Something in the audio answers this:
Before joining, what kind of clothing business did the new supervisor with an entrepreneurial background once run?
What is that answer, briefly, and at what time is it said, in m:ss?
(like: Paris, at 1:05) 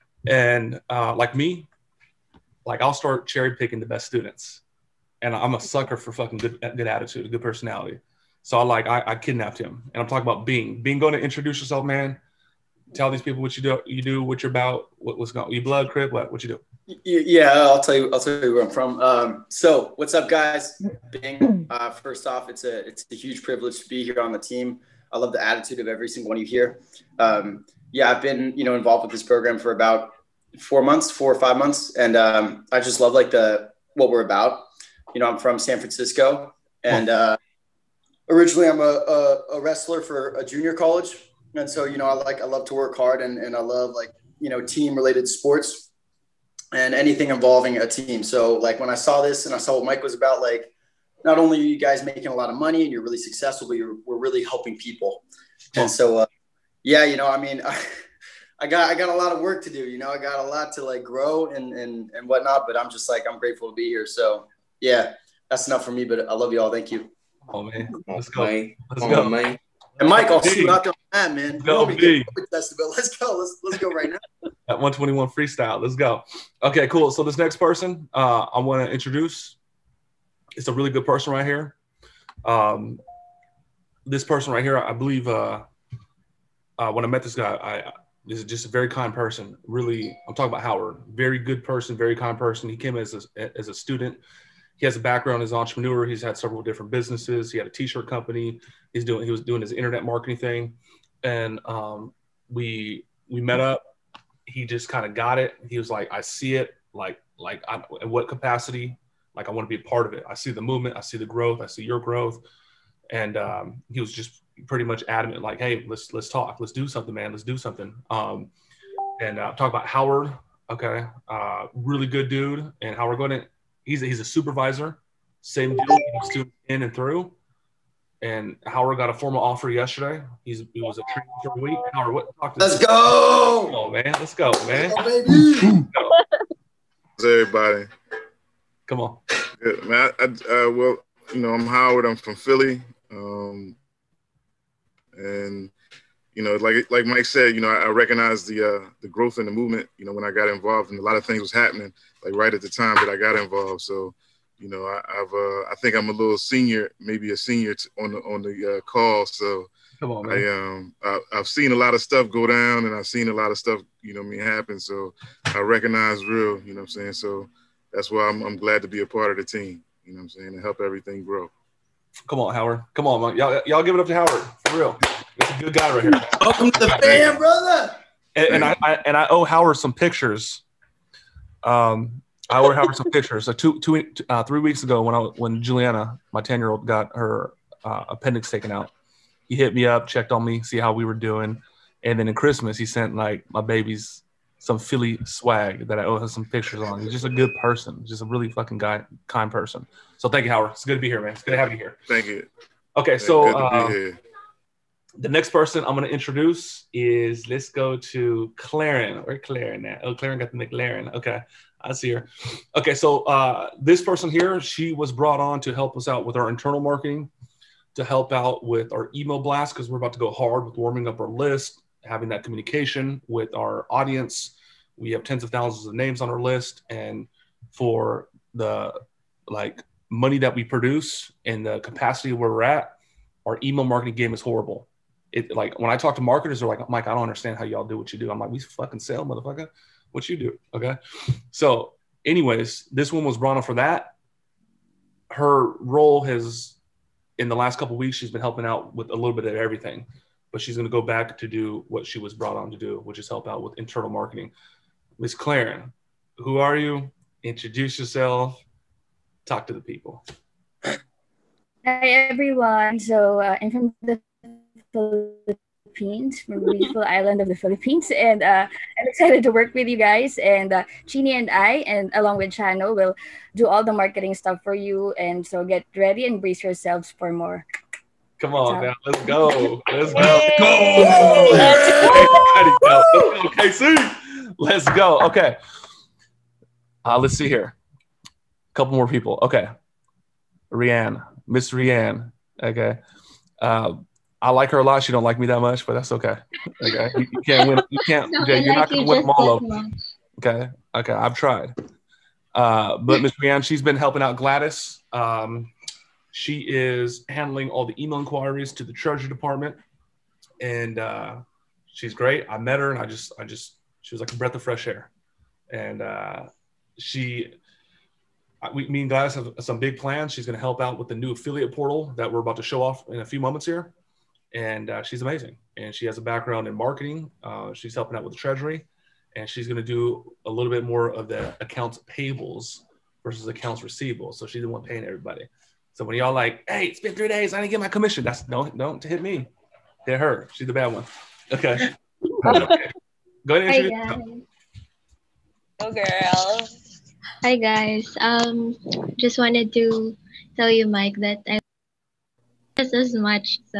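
T-shirt company, at 1:37.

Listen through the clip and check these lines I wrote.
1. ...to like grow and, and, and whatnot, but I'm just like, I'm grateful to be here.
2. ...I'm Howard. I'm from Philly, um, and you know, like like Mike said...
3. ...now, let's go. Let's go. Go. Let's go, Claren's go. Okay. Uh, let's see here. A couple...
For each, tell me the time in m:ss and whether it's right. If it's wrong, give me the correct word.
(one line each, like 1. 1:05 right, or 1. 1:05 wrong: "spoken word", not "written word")
1. 1:00 right
2. 2:21 right
3. 4:38 wrong: "Let", not "Claren".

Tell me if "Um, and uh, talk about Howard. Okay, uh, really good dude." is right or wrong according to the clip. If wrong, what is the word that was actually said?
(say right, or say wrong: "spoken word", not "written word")
right.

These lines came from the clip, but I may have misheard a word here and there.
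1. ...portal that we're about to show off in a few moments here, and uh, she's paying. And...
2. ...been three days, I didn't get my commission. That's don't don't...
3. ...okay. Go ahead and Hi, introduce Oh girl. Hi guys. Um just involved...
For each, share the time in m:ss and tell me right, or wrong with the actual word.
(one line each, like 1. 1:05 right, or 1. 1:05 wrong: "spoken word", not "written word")
1. 5:21 wrong: "amazing", not "paying"
2. 5:37 right
3. 5:42 wrong: "wanted", not "involved".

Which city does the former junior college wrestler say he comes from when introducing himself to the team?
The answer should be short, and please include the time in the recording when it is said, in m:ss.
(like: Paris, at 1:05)
San Francisco, at 0:35.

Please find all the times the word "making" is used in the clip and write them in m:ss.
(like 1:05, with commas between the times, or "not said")
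0:52.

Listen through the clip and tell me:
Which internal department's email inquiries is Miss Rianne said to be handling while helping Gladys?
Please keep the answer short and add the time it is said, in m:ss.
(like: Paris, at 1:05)
Treasury Department, at 5:08.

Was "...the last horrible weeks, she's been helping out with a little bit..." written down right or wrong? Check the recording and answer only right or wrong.
wrong.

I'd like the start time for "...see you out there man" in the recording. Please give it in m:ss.
1:10.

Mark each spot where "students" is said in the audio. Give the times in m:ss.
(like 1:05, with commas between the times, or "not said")
0:04, 1:33.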